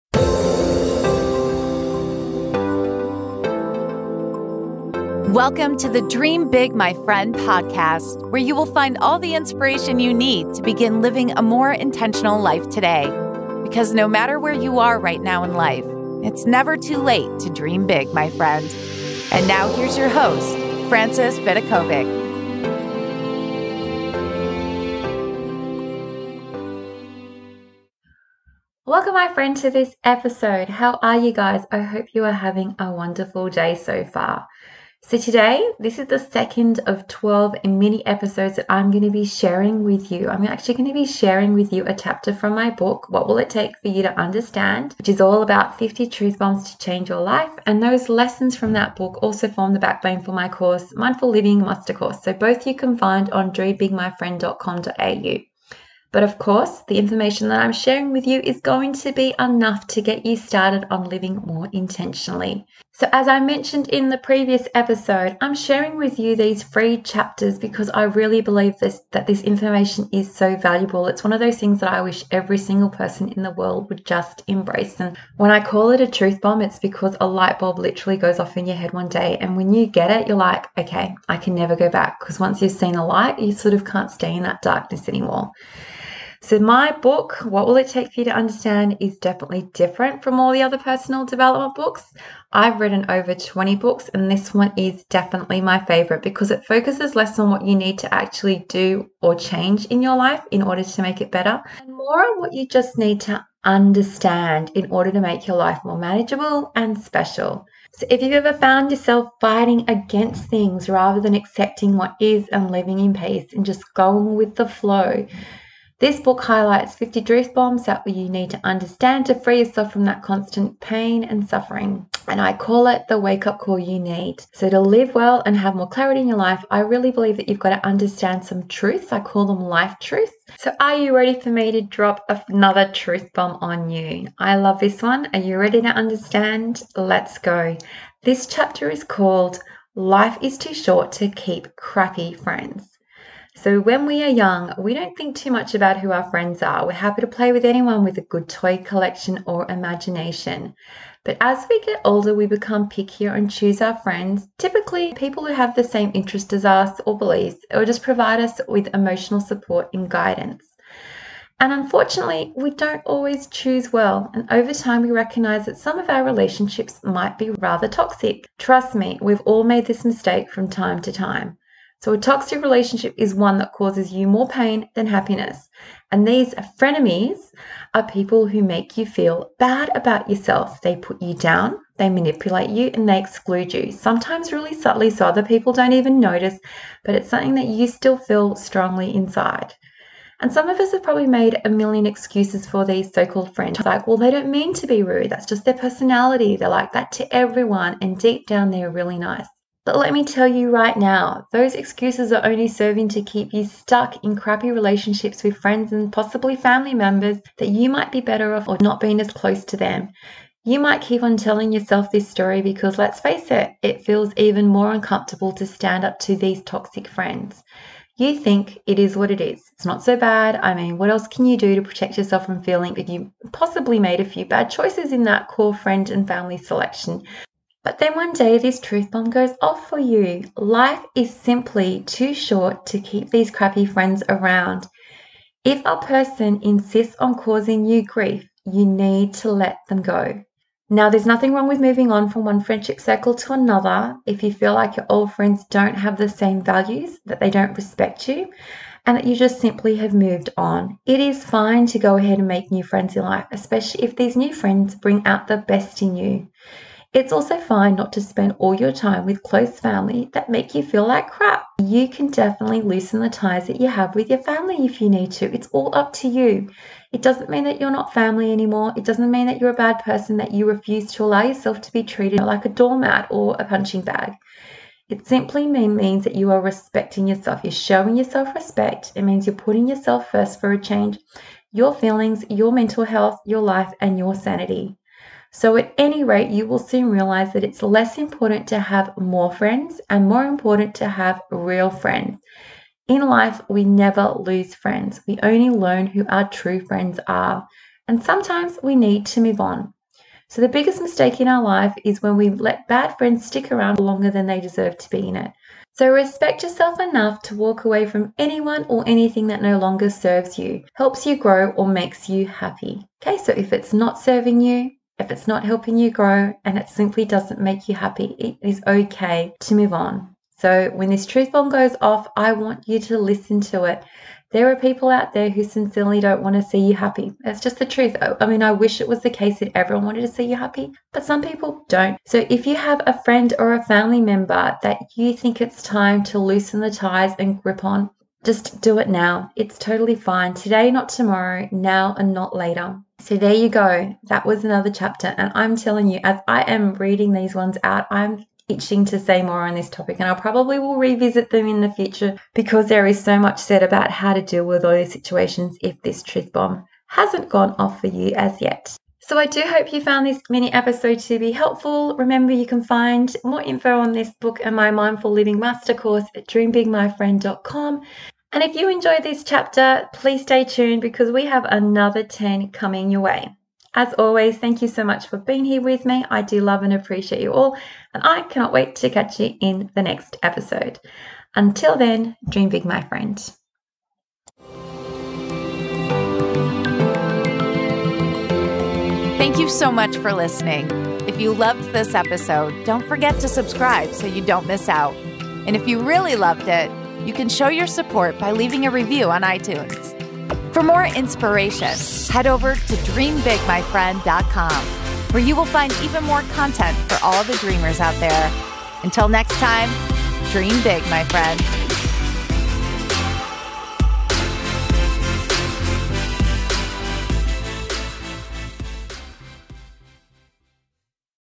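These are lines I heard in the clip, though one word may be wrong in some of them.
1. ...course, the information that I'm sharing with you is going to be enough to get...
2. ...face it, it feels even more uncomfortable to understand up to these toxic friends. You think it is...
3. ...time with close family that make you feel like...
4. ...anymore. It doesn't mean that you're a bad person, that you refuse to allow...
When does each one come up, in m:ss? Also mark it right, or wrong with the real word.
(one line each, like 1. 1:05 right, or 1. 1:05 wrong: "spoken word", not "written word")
1. 0:56 right
2. 3:33 wrong: "stand", not "understand"
3. 4:18 right
4. 4:28 right.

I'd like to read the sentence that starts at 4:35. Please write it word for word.
It simply means that you are respecting yourself.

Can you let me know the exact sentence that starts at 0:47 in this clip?
And those lessons from that book also form the backbone for my course, Mindful Living Master Course.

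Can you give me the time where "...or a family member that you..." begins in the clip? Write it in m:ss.
5:33.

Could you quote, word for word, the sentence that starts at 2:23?
So, when we are young, we don't think too much about who our friends are.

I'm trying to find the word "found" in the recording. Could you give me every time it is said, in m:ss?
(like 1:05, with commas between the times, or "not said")
1:48, 6:00.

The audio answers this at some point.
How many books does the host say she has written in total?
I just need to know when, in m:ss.
1:33.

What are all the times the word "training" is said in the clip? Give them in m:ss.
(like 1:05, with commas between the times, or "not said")
not said.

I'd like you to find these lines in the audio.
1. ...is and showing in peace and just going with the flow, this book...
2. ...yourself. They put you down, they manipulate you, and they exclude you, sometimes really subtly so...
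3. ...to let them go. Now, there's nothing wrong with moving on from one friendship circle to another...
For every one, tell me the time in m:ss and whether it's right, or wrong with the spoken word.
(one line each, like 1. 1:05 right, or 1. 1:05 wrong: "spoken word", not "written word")
1. 1:52 wrong: "living", not "showing"
2. 3:00 right
3. 3:59 right.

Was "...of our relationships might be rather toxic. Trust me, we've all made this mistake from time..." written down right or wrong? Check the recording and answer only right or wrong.
right.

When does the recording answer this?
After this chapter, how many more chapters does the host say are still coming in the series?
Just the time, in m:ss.
6:12.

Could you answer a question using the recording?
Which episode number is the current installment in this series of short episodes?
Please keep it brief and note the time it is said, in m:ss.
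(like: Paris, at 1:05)
second, at 0:36.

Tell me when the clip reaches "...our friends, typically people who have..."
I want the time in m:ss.
2:33.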